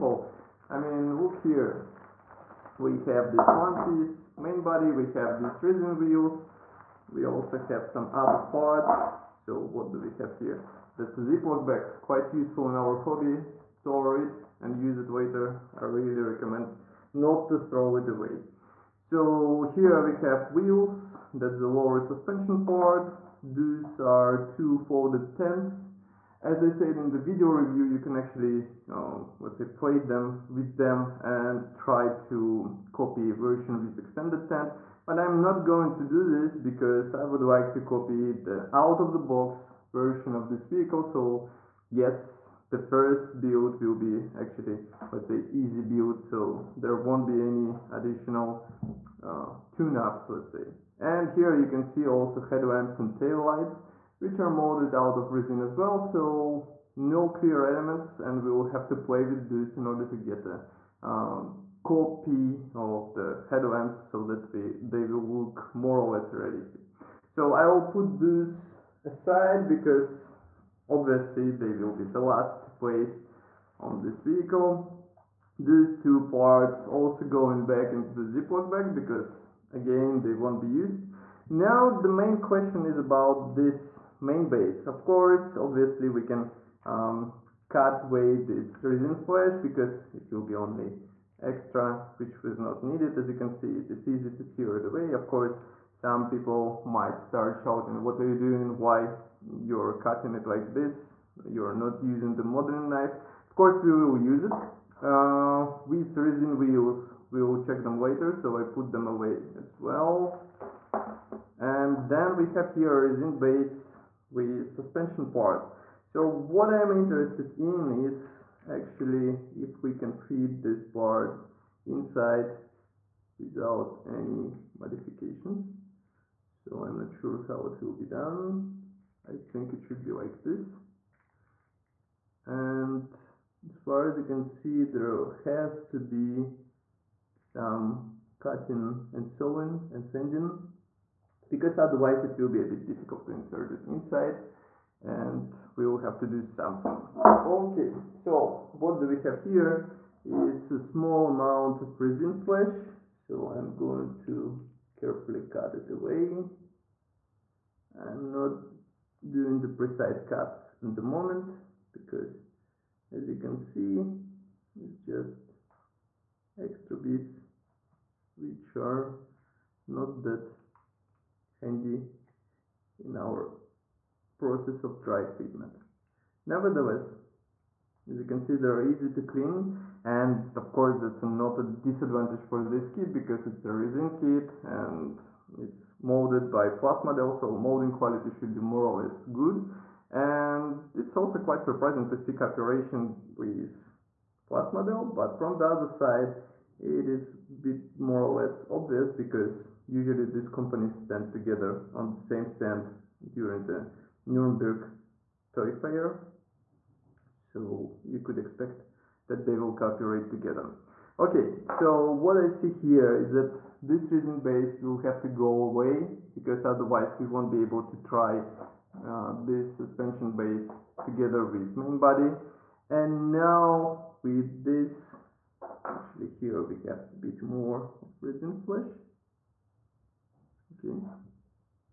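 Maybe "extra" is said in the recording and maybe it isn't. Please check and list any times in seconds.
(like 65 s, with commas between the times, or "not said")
91 s, 166 s.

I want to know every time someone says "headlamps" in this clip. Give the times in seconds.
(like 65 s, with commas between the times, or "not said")
52 s, 63 s.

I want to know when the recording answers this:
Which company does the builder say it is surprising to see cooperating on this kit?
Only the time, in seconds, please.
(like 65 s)
194 s.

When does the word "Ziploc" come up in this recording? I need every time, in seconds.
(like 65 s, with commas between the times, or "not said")
11 s, 78 s.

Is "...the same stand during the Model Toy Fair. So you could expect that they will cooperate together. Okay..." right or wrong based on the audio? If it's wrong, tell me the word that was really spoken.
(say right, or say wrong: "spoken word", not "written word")
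wrong: "Nuremberg", not "Model".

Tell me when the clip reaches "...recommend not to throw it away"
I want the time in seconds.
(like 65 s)
16 s.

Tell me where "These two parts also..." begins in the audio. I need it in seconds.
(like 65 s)
75 s.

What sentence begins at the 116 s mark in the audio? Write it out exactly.
So what I'm interested in is actually if we can fit this part inside without any modifications.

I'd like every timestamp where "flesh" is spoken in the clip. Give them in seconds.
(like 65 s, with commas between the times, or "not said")
89 s, 152 s, 228 s.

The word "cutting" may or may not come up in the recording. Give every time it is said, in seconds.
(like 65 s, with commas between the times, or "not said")
99 s, 138 s.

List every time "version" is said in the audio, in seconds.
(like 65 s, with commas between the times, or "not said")
33 s, 39 s.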